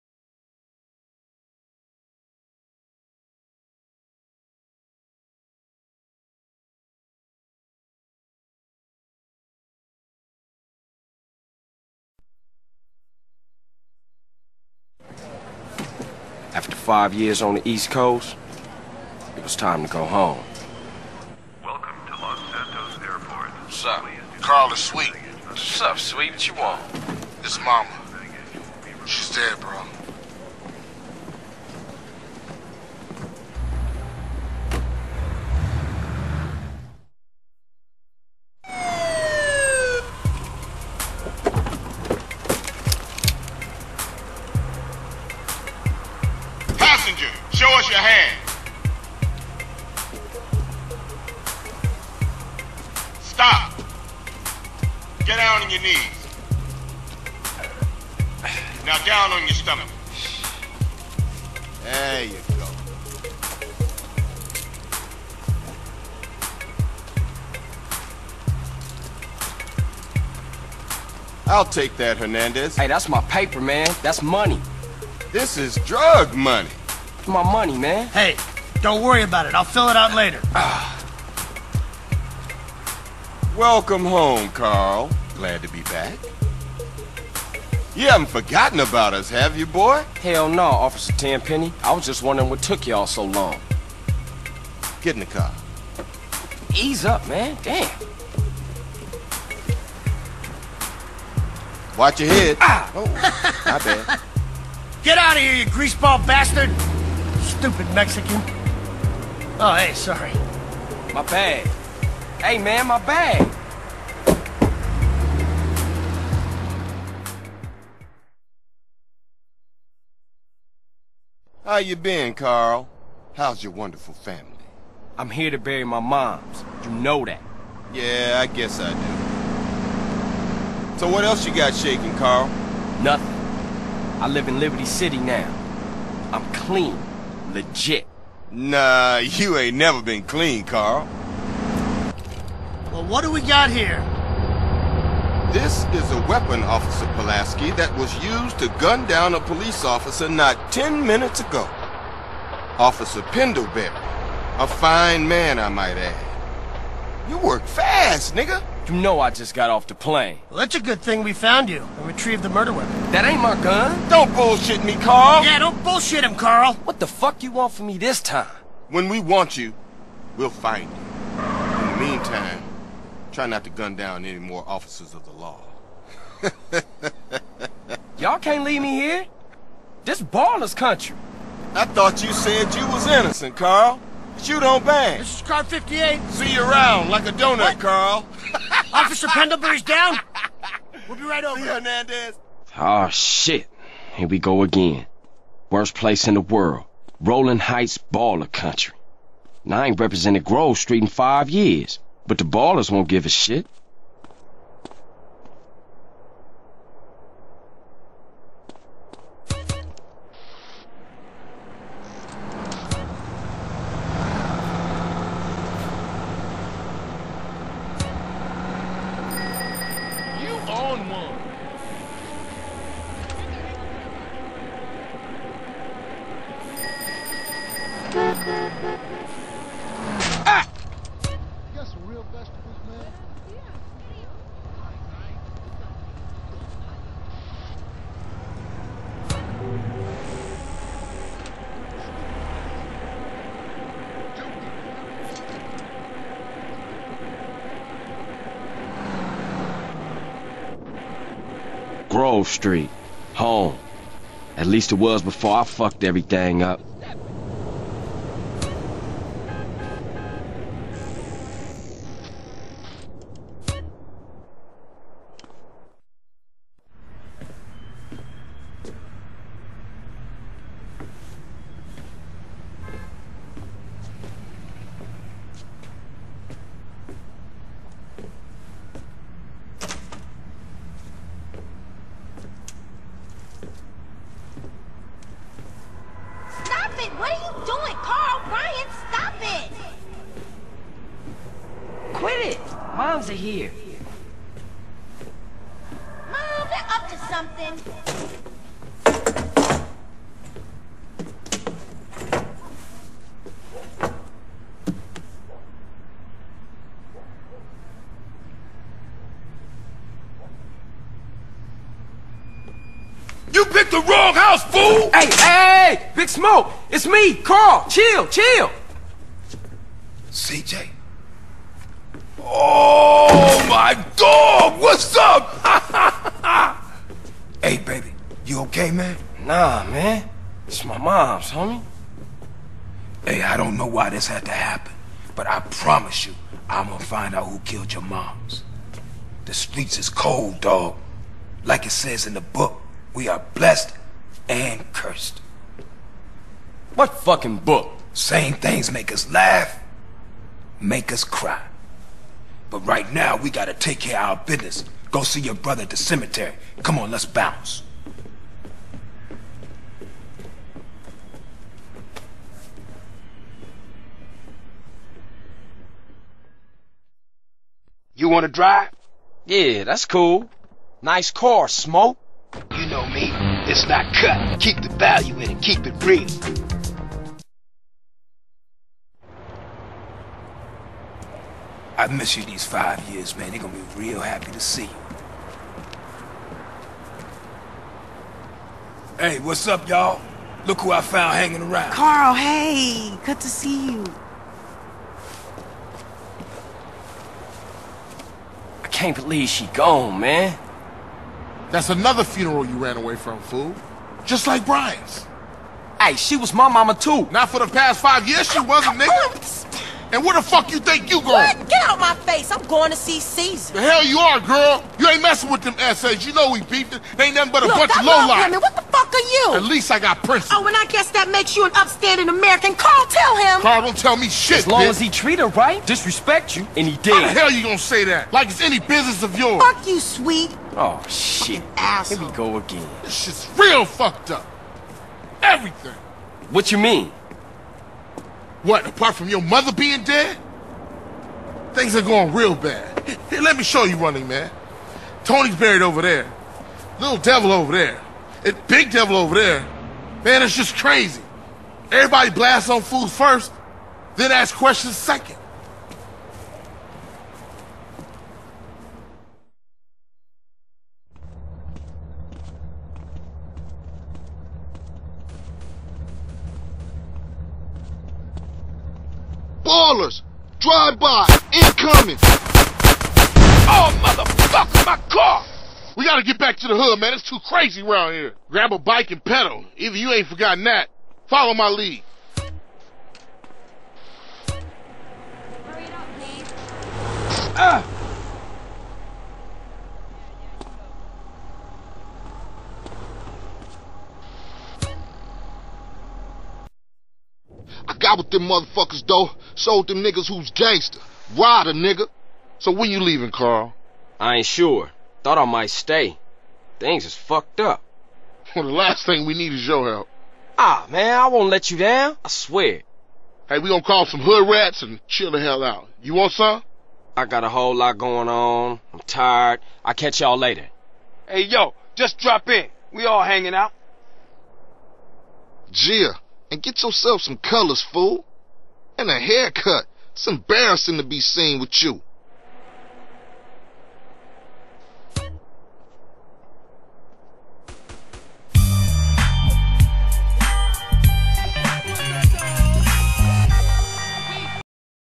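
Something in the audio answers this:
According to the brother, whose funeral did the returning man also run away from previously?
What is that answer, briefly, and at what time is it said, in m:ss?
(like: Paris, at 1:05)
Brian, at 6:44.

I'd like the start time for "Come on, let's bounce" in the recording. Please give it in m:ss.
5:56.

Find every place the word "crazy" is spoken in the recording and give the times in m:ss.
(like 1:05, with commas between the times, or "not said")
7:30, 7:57.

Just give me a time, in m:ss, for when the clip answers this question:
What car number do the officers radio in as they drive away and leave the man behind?
3:05.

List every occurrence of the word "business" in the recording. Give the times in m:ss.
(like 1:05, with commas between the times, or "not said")
5:54, 7:08.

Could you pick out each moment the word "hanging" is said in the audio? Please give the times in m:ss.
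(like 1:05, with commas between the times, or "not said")
6:31, 8:43.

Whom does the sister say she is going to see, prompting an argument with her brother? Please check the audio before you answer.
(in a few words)
Cesar.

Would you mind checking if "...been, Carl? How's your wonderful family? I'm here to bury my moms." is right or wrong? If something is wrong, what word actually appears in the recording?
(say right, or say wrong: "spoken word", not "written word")
right.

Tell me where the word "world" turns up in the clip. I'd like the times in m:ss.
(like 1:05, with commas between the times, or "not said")
3:16.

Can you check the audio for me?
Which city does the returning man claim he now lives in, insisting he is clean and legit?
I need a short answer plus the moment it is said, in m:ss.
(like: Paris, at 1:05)
Liberty City, at 2:14.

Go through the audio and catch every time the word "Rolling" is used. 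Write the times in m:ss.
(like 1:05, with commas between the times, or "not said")
3:17.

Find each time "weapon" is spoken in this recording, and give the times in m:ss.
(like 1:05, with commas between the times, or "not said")
2:26, 2:42.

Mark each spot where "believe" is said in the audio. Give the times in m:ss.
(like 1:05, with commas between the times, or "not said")
6:39.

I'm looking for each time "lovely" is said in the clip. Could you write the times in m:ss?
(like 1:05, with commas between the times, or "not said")
not said.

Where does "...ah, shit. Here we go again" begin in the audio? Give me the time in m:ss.
3:12.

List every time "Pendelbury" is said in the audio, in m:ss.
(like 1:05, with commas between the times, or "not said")
2:33, 3:09.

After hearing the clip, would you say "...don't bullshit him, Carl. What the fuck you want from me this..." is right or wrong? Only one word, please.
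right.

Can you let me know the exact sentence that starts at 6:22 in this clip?
I've missed you these five years, man.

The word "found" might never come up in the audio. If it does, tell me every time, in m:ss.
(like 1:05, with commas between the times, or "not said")
2:41, 6:31.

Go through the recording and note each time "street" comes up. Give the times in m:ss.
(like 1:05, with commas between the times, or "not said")
3:20, 4:12, 5:39.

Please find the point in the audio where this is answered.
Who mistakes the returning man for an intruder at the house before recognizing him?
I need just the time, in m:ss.
5:16.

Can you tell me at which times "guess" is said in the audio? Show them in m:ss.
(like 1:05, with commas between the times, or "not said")
2:08, 7:00.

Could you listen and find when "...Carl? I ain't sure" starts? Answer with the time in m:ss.
8:23.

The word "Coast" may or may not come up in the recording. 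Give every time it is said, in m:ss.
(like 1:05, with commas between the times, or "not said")
0:17.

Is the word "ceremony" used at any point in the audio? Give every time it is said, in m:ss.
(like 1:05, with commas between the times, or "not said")
not said.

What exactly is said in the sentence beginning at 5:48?
Same things make us laugh, make us cry.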